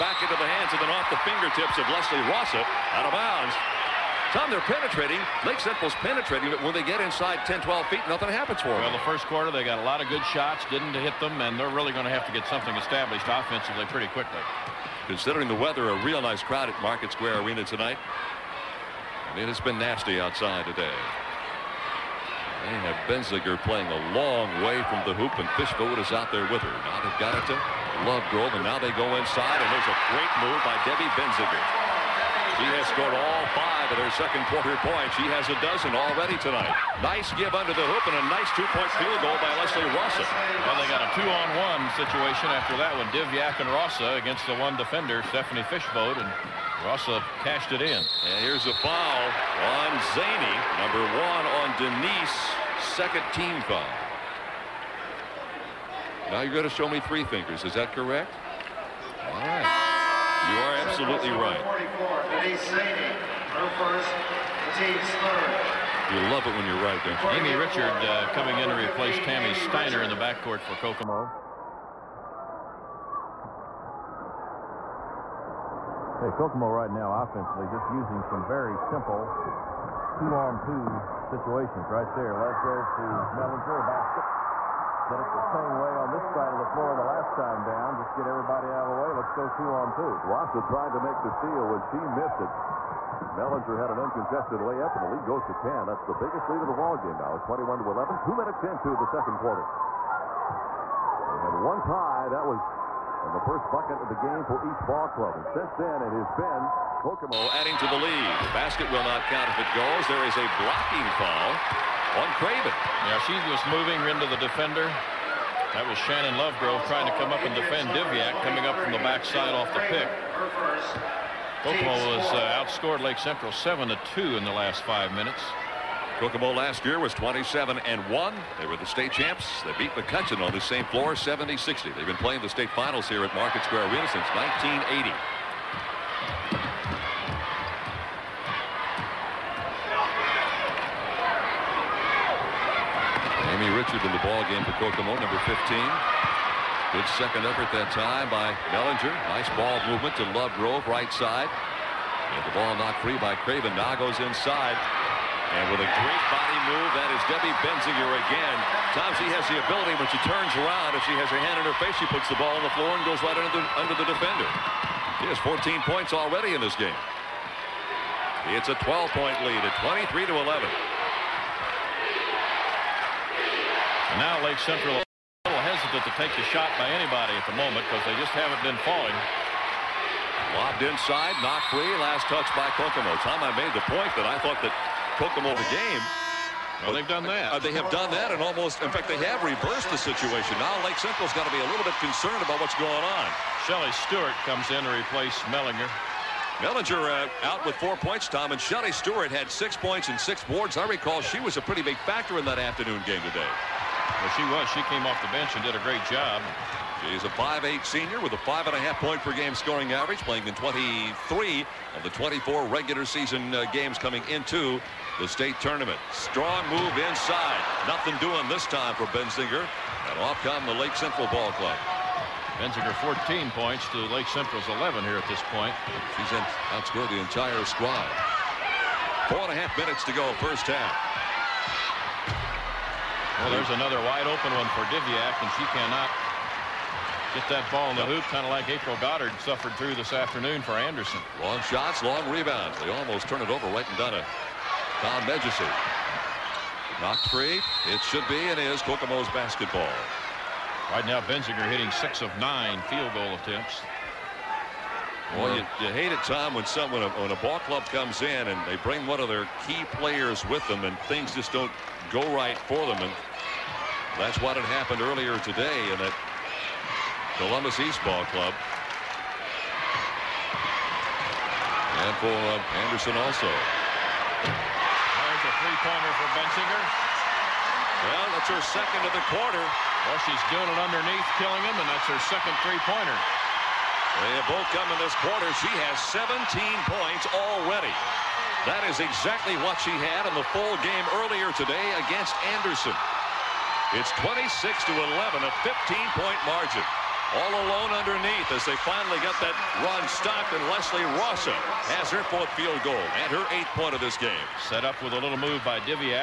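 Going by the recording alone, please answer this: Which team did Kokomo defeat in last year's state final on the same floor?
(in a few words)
McCutcheon.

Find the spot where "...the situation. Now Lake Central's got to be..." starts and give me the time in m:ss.
3:09.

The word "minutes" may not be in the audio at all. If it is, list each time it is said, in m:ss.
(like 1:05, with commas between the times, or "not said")
1:38, 2:05, 3:49.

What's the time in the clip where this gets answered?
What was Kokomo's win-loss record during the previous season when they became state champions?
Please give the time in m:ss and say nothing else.
2:07.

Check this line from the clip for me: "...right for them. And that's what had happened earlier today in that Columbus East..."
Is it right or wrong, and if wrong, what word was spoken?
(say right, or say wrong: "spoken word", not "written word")
right.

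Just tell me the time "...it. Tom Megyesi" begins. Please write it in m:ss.
4:04.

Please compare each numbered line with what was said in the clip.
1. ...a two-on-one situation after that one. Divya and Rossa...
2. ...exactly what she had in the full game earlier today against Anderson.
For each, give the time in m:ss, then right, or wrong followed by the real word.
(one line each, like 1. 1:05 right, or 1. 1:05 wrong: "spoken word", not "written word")
1. 0:41 right
2. 4:49 right.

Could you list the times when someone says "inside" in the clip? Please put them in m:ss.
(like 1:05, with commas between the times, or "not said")
0:07, 0:29, 2:34, 3:00, 3:37.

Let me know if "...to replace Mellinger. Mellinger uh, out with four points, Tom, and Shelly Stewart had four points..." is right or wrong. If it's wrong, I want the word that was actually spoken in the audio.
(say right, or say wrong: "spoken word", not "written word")
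wrong: "six", not "four".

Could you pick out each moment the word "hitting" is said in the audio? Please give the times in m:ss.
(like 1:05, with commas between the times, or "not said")
4:11.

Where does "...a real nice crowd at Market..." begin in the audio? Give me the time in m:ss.
0:15.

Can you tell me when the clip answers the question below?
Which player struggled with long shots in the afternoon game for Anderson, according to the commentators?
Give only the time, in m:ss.
3:58.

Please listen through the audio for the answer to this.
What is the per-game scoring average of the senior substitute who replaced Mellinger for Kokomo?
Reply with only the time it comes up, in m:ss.
3:28.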